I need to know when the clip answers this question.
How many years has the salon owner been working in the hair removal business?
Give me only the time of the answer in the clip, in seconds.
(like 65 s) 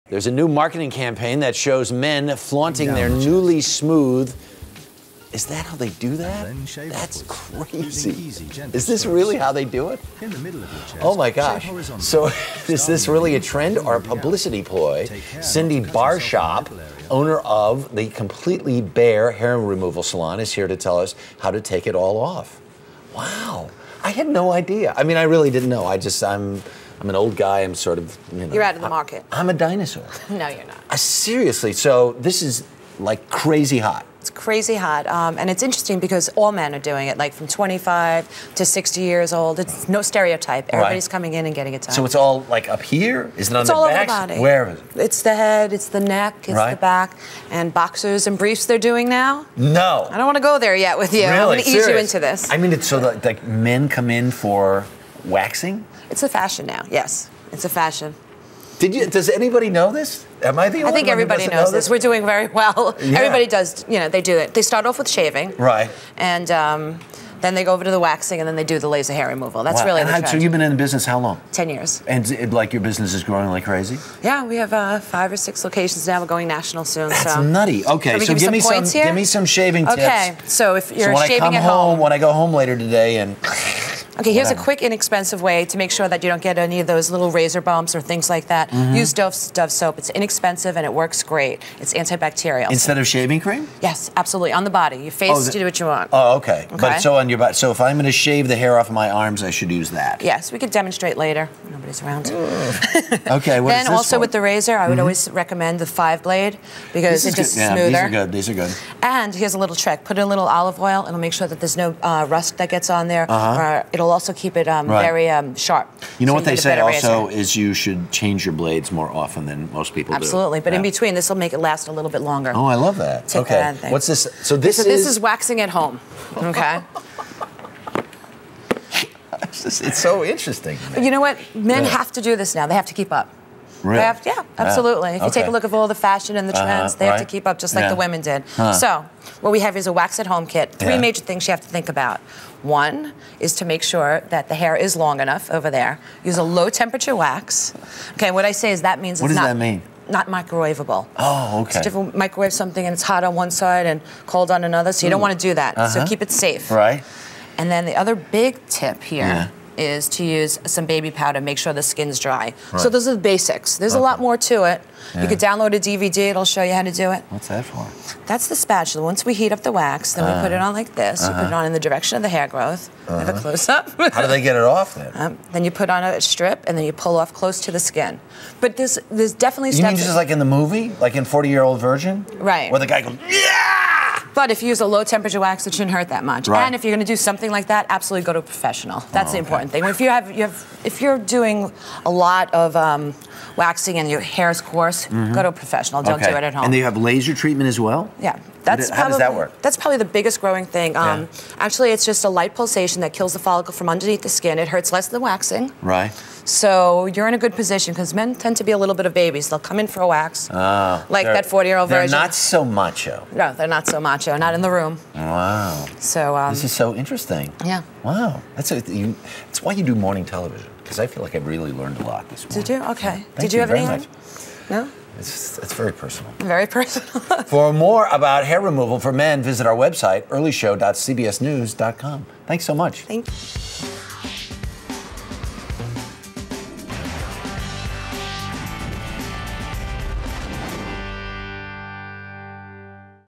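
71 s.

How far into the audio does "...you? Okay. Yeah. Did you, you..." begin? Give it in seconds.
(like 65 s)
222 s.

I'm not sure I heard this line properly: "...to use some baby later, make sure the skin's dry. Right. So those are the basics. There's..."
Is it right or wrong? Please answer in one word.
wrong.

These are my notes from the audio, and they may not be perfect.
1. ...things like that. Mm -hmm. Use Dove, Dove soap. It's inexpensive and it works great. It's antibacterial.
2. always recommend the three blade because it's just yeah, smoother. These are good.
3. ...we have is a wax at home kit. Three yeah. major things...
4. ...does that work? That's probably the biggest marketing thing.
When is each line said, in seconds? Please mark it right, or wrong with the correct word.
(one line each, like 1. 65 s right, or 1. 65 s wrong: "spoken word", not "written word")
1. 88 s right
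2. 105 s wrong: "five", not "three"
3. 139 s right
4. 199 s wrong: "growing", not "marketing".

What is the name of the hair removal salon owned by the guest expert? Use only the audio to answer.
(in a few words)
Completely Bare.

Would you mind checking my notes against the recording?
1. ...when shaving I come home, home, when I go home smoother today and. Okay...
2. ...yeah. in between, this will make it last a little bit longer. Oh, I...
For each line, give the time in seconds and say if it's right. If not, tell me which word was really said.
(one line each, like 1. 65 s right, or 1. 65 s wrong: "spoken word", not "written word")
1. 81 s wrong: "later", not "smoother"
2. 120 s right.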